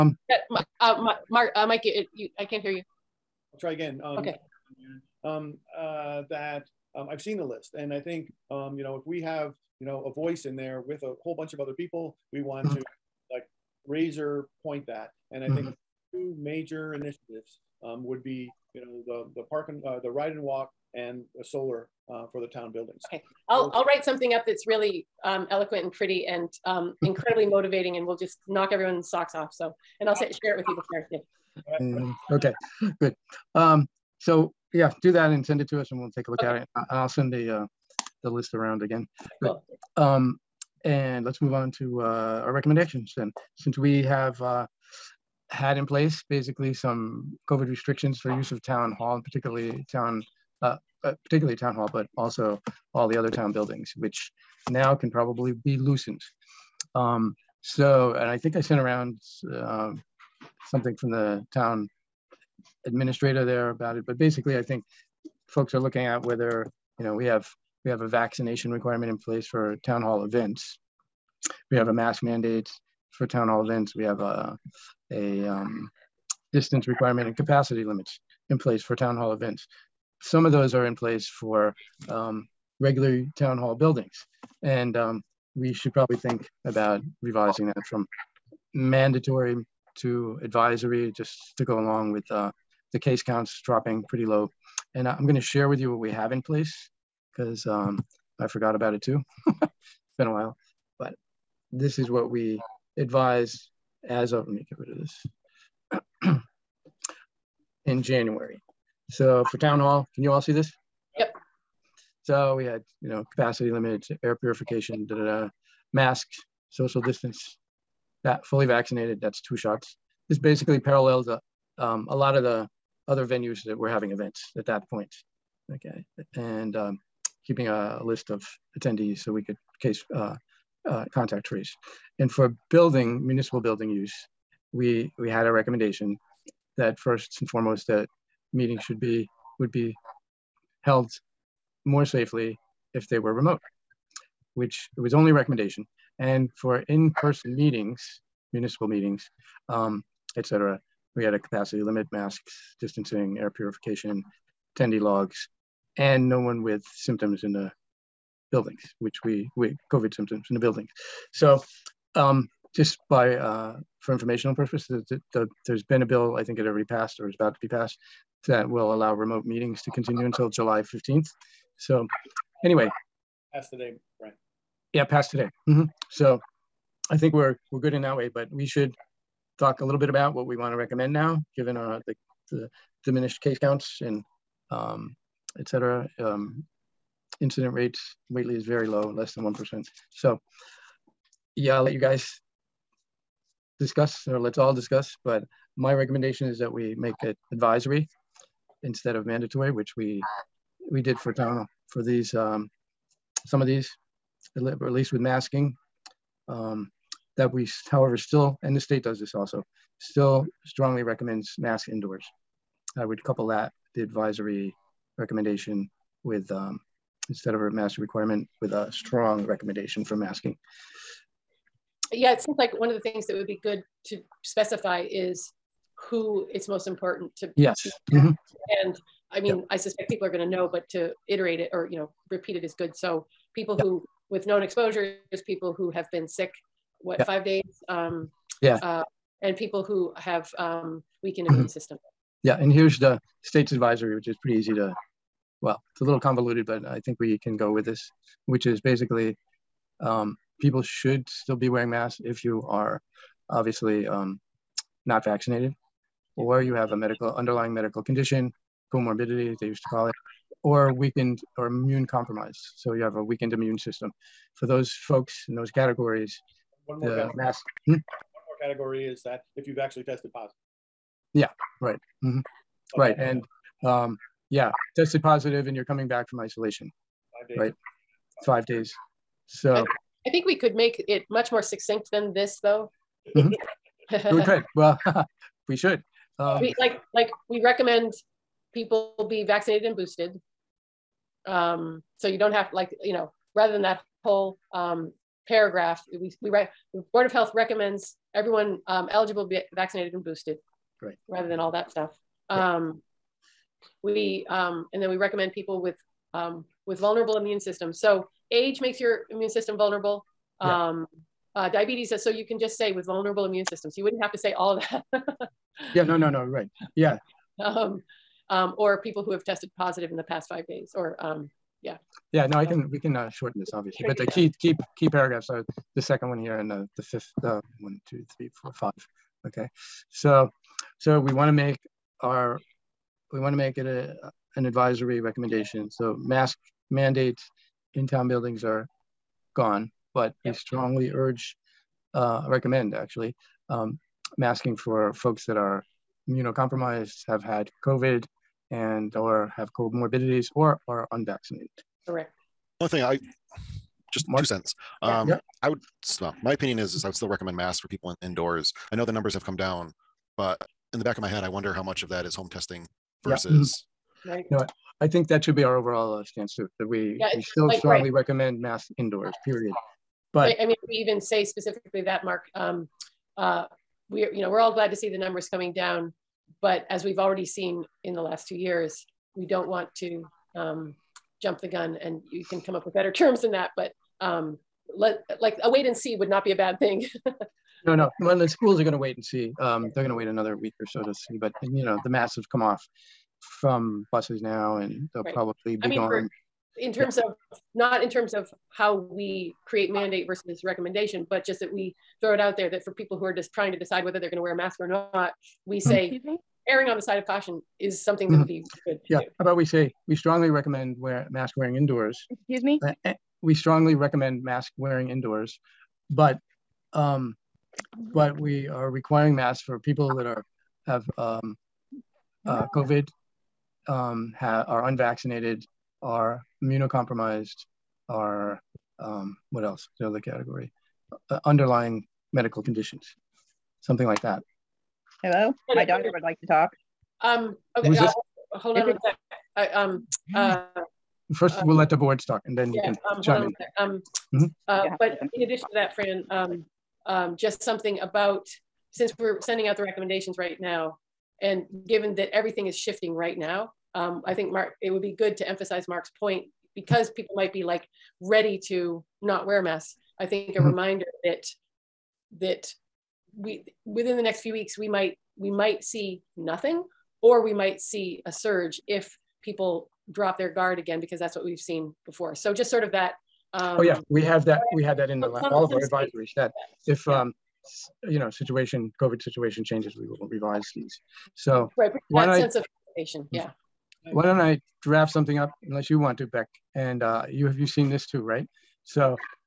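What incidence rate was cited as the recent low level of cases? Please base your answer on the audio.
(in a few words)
Less than 1%.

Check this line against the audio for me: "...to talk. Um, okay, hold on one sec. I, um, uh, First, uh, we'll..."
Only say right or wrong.
right.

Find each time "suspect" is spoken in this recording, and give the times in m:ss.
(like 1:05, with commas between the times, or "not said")
3:49.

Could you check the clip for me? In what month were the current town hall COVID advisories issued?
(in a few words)
January.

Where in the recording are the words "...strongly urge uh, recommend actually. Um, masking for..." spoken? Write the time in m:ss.
5:40.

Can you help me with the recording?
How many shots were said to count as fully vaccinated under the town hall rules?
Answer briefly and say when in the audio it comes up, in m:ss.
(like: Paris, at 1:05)
2, at 1:59.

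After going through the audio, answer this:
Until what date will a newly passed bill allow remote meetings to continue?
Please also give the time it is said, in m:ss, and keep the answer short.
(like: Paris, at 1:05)
July 15th, at 2:50.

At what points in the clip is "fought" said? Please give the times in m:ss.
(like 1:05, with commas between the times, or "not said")
not said.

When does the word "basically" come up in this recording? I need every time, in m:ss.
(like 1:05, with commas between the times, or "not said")
0:46, 1:04, 2:00, 4:08.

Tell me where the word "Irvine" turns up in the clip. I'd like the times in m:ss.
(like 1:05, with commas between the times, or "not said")
not said.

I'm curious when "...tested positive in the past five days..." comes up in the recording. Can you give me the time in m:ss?
5:19.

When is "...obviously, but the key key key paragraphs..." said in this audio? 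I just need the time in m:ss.
5:23.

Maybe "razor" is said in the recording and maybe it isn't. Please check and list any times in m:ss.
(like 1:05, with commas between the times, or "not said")
0:13.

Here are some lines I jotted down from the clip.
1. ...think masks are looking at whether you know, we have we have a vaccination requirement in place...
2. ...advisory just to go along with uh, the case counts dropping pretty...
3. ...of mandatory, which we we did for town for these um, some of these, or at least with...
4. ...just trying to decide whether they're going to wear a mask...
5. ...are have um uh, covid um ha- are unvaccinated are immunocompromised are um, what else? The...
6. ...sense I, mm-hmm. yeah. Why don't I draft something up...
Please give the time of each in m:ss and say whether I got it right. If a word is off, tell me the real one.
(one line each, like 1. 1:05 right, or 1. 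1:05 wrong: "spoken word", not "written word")
1. 1:04 wrong: "folks", not "masks"
2. 1:30 right
3. 3:19 right
4. 6:43 right
5. 7:00 right
6. 8:02 right.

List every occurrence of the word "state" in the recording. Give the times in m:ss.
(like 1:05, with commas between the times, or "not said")
3:28, 4:03.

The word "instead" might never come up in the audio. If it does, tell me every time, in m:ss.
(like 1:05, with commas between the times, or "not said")
3:18, 3:37.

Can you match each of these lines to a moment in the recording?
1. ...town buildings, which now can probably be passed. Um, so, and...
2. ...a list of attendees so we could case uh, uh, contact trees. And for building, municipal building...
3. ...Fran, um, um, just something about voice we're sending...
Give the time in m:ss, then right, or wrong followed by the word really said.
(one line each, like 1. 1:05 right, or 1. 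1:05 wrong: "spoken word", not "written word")
1. 0:53 wrong: "loosened", not "passed"
2. 2:07 right
3. 7:25 wrong: "since", not "voice".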